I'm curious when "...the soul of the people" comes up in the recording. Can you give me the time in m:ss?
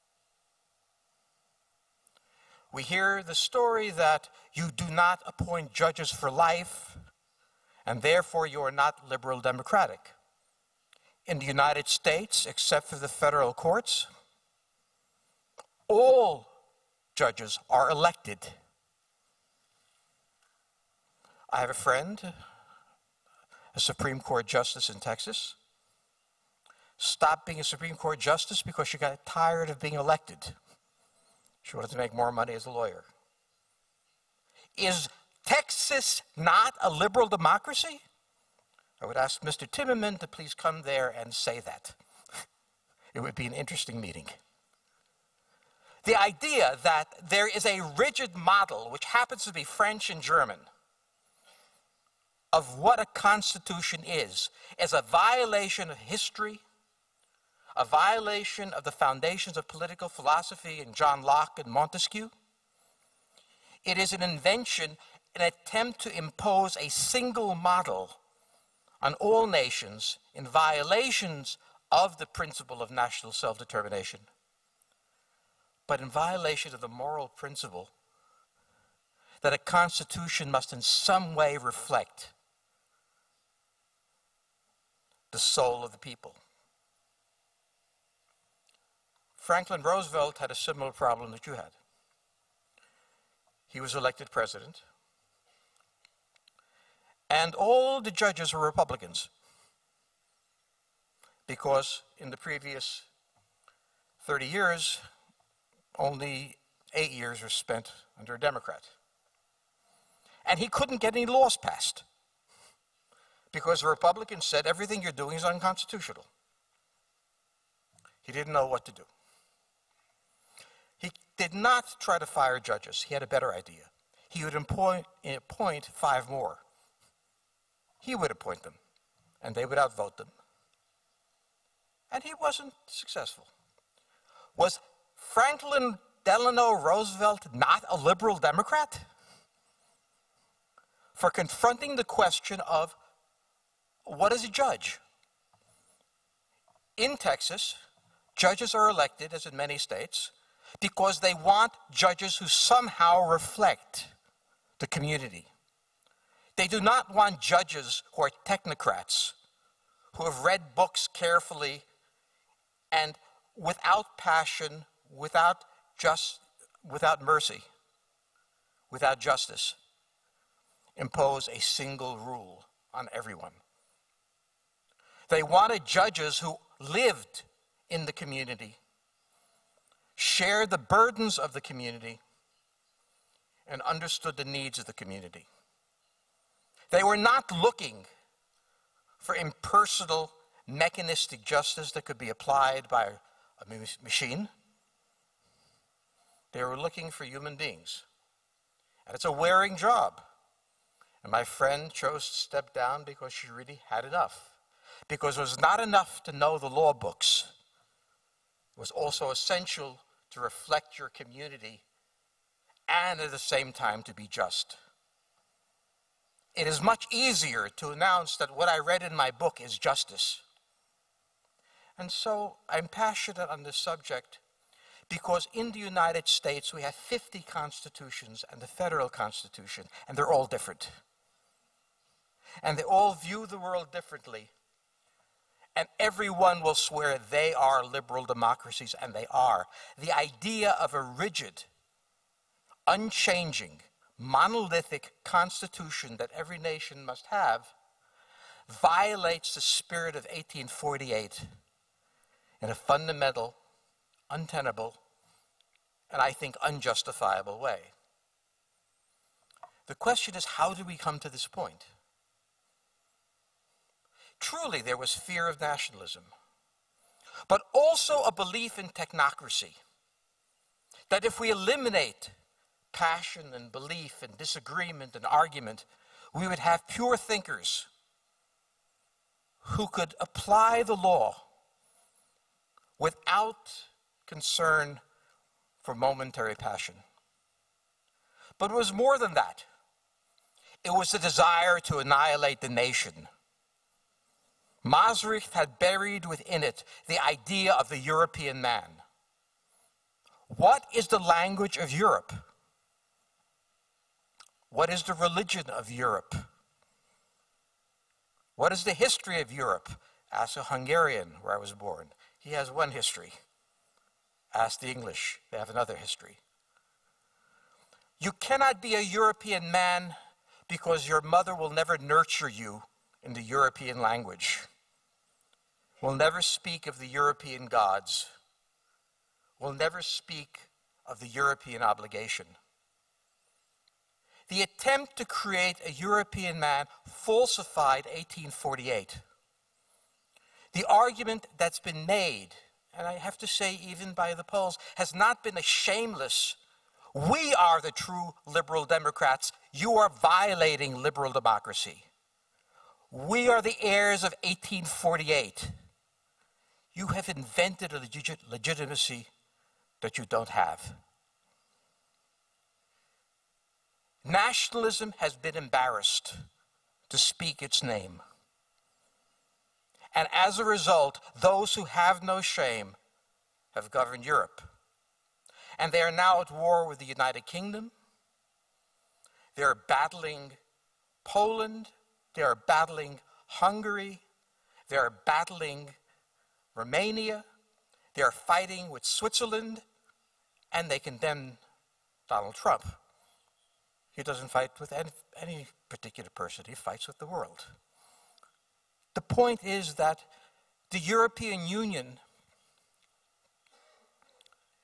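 1:25.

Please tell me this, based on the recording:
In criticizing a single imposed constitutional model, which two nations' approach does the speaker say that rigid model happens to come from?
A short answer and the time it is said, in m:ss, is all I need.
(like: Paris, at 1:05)
French and German, at 0:49.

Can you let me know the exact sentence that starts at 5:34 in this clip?
The attempt to create a European man falsified 1848.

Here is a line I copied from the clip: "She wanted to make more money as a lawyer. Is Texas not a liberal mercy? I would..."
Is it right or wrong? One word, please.
wrong.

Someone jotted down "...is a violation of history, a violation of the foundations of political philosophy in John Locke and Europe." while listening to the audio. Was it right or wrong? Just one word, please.
wrong.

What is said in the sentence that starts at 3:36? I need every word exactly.
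It is much easier to announce that what I read in my book is justice.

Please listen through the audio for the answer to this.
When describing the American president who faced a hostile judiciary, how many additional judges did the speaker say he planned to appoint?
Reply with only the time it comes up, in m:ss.
2:05.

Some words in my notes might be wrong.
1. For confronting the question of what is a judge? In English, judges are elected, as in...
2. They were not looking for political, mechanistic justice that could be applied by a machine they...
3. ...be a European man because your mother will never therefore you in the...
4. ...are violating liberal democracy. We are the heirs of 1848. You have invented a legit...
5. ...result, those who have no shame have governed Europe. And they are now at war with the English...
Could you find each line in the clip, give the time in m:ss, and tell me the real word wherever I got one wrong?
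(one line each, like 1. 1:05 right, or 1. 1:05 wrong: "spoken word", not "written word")
1. 2:21 wrong: "Texas", not "English"
2. 3:06 wrong: "impersonal", not "political"
3. 5:18 wrong: "nurture", not "therefore"
4. 5:49 right
5. 6:10 wrong: "United", not "English".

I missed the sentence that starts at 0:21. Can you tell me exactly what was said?
I have a friend, a Supreme Court justice in Texas.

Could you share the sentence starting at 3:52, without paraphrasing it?
And they all view the world differently.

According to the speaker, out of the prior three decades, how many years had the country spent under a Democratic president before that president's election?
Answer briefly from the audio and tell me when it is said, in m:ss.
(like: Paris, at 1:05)
8, at 1:46.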